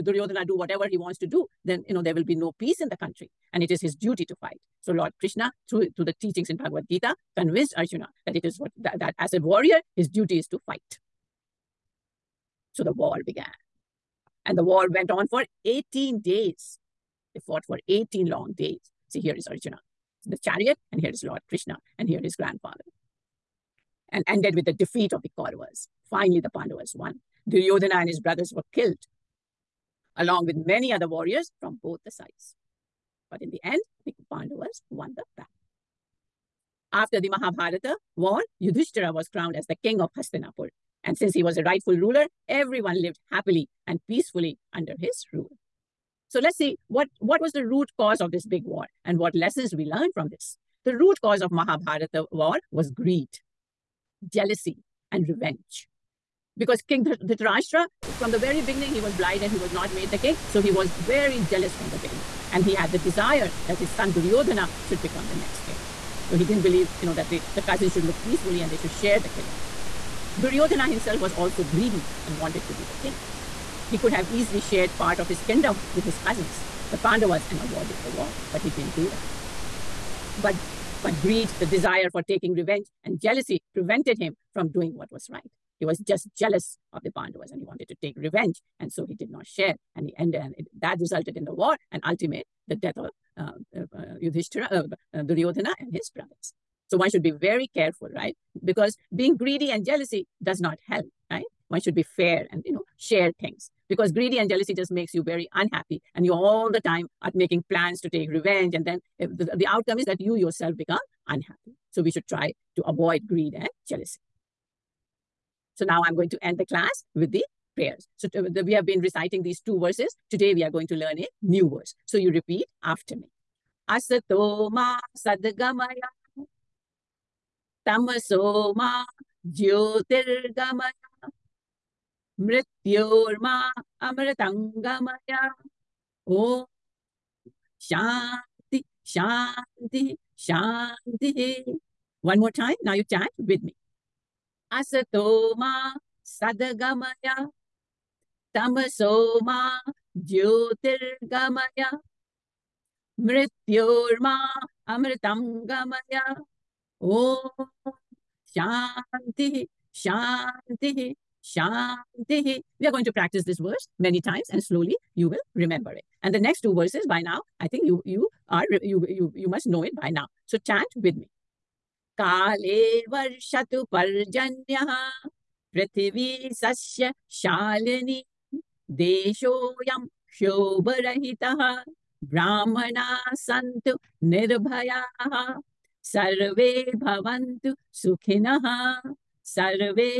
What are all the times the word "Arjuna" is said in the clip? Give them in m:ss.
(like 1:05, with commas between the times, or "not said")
0:07, 0:19.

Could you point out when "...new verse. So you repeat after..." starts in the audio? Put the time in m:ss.
2:01.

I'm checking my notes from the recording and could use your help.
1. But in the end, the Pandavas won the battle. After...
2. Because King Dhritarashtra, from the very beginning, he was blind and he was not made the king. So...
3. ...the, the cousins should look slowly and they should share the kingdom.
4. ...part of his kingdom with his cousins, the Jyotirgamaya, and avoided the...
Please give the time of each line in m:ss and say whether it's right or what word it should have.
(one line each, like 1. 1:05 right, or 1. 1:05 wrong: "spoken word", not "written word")
1. 0:33 right
2. 0:56 right
3. 1:07 wrong: "peacefully", not "slowly"
4. 1:14 wrong: "Pandavas", not "Jyotirgamaya".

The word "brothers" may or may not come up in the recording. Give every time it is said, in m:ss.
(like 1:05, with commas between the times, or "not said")
0:28, 1:36.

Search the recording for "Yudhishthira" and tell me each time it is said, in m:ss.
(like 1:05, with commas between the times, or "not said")
0:38, 1:34.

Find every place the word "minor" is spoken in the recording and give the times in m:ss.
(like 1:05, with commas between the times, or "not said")
not said.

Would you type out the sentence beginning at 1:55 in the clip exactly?
So now I'm going to end the class with the prayers.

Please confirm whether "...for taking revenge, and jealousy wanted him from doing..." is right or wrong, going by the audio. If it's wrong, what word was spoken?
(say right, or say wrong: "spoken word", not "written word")
wrong: "prevented", not "wanted".